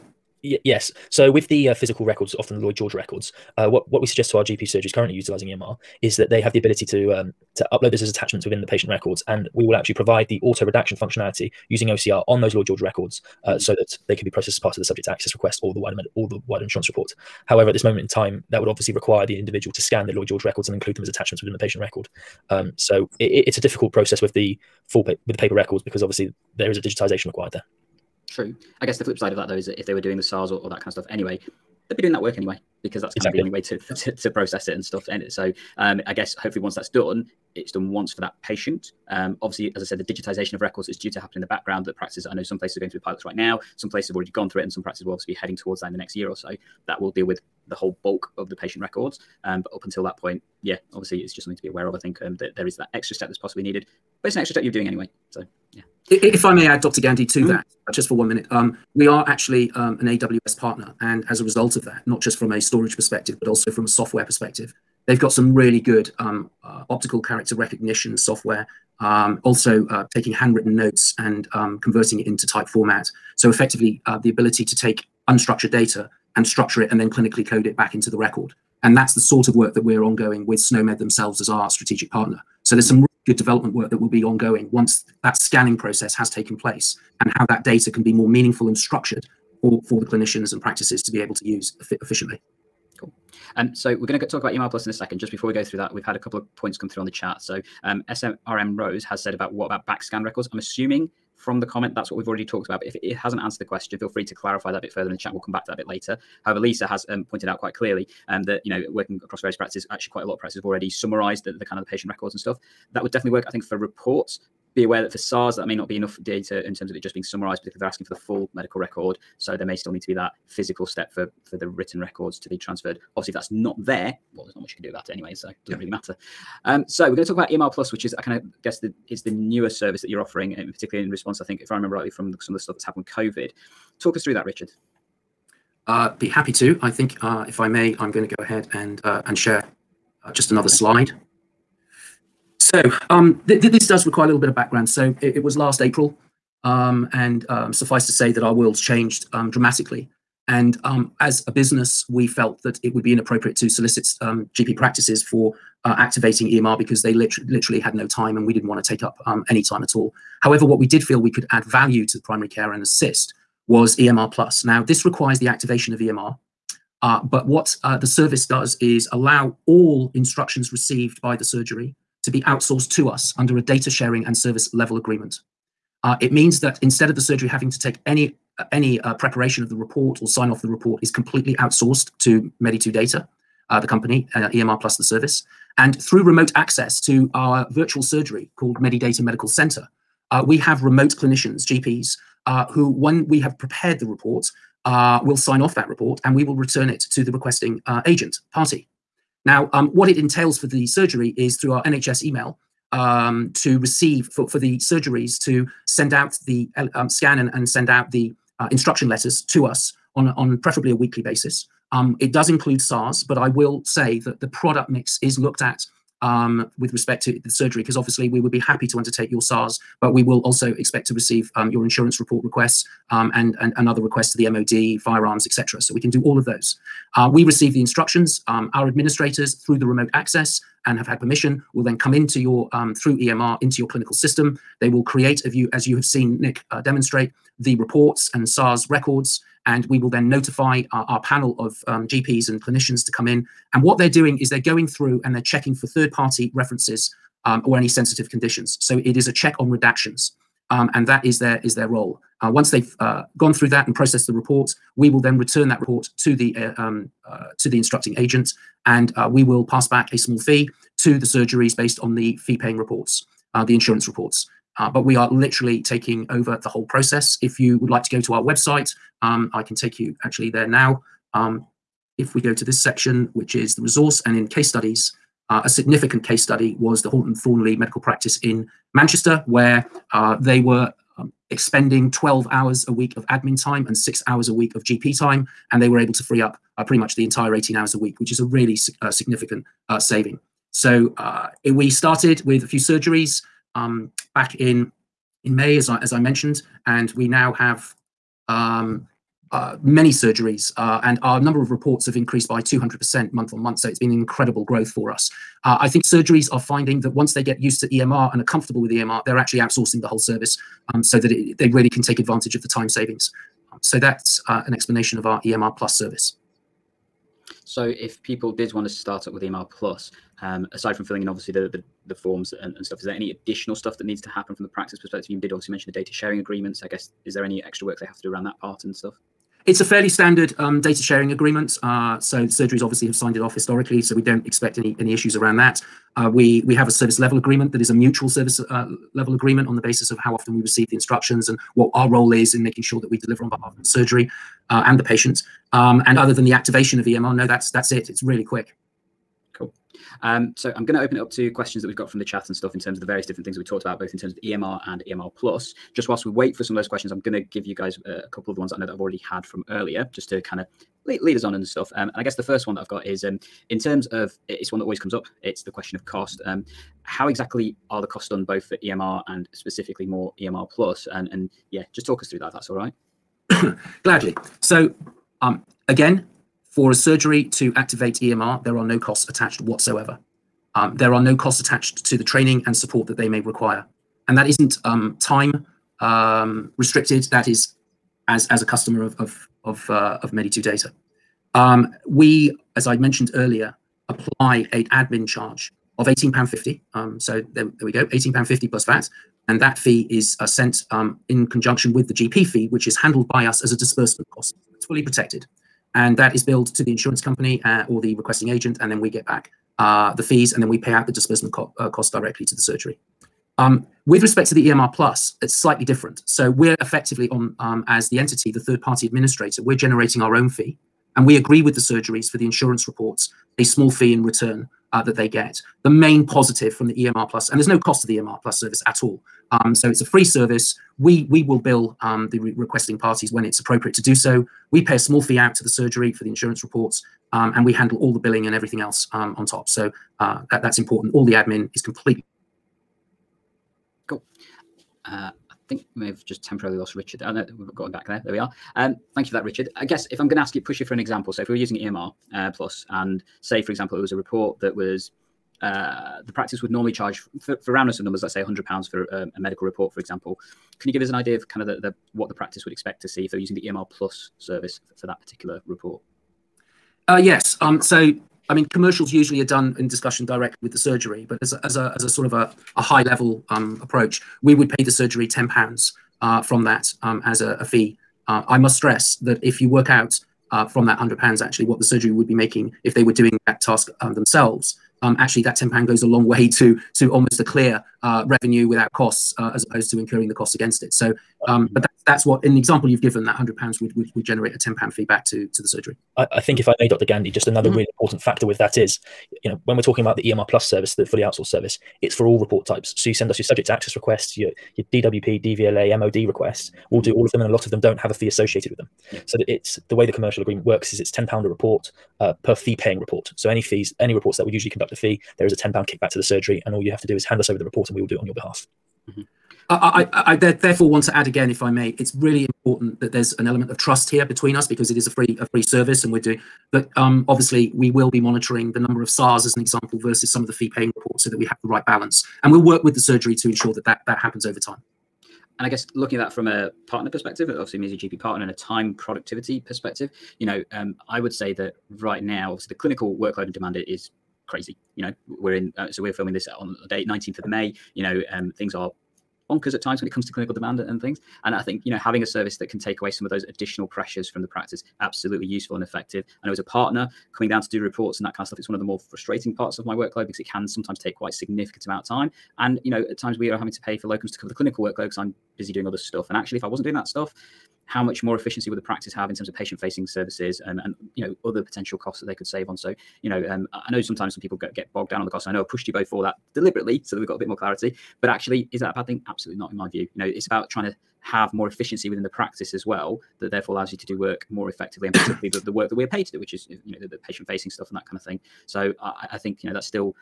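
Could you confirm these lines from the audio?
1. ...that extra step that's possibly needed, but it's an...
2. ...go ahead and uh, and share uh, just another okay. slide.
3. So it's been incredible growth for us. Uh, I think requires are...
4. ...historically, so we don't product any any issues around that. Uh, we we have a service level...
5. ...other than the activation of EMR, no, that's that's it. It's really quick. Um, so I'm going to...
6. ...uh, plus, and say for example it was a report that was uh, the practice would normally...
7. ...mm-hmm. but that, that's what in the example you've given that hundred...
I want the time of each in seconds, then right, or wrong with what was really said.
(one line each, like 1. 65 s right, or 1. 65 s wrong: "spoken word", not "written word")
1. 52 s right
2. 138 s right
3. 303 s wrong: "surgeries", not "requires"
4. 333 s wrong: "expect", not "product"
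5. 346 s right
6. 452 s right
7. 491 s right.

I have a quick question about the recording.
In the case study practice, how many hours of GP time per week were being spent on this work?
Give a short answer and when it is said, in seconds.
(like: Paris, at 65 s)
6 hours, at 283 s.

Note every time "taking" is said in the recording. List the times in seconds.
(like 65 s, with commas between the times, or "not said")
70 s, 265 s.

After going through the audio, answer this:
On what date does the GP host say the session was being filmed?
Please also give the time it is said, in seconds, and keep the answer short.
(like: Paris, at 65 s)
19th of May, at 547 s.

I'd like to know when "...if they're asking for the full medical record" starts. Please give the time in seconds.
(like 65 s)
117 s.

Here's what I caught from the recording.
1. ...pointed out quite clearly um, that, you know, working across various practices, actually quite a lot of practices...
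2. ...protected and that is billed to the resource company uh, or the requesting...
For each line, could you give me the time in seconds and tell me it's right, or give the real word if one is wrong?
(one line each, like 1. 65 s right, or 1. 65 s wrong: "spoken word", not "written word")
1. 107 s right
2. 405 s wrong: "insurance", not "resource".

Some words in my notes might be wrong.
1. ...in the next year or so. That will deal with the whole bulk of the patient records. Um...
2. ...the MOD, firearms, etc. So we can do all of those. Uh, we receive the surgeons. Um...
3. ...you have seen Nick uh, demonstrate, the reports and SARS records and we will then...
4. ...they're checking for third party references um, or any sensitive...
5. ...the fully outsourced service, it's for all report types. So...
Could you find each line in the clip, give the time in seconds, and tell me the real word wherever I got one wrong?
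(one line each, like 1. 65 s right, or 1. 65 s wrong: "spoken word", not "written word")
1. 45 s right
2. 224 s wrong: "instructions", not "surgeons"
3. 235 s right
4. 245 s right
5. 500 s right.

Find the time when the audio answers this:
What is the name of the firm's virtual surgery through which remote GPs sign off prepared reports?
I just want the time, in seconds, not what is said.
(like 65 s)
188 s.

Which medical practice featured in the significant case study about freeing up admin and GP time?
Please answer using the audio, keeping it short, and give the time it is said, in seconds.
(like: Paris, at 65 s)
Horton Thornley medical practice, at 277 s.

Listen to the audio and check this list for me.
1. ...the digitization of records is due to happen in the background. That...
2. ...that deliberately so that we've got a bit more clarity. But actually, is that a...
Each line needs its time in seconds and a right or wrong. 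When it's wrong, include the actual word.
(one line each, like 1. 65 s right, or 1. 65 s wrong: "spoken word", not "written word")
1. 39 s right
2. 576 s right.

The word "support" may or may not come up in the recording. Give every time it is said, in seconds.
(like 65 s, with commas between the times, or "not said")
382 s.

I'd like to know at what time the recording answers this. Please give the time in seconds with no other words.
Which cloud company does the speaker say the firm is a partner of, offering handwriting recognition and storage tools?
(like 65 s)
60 s.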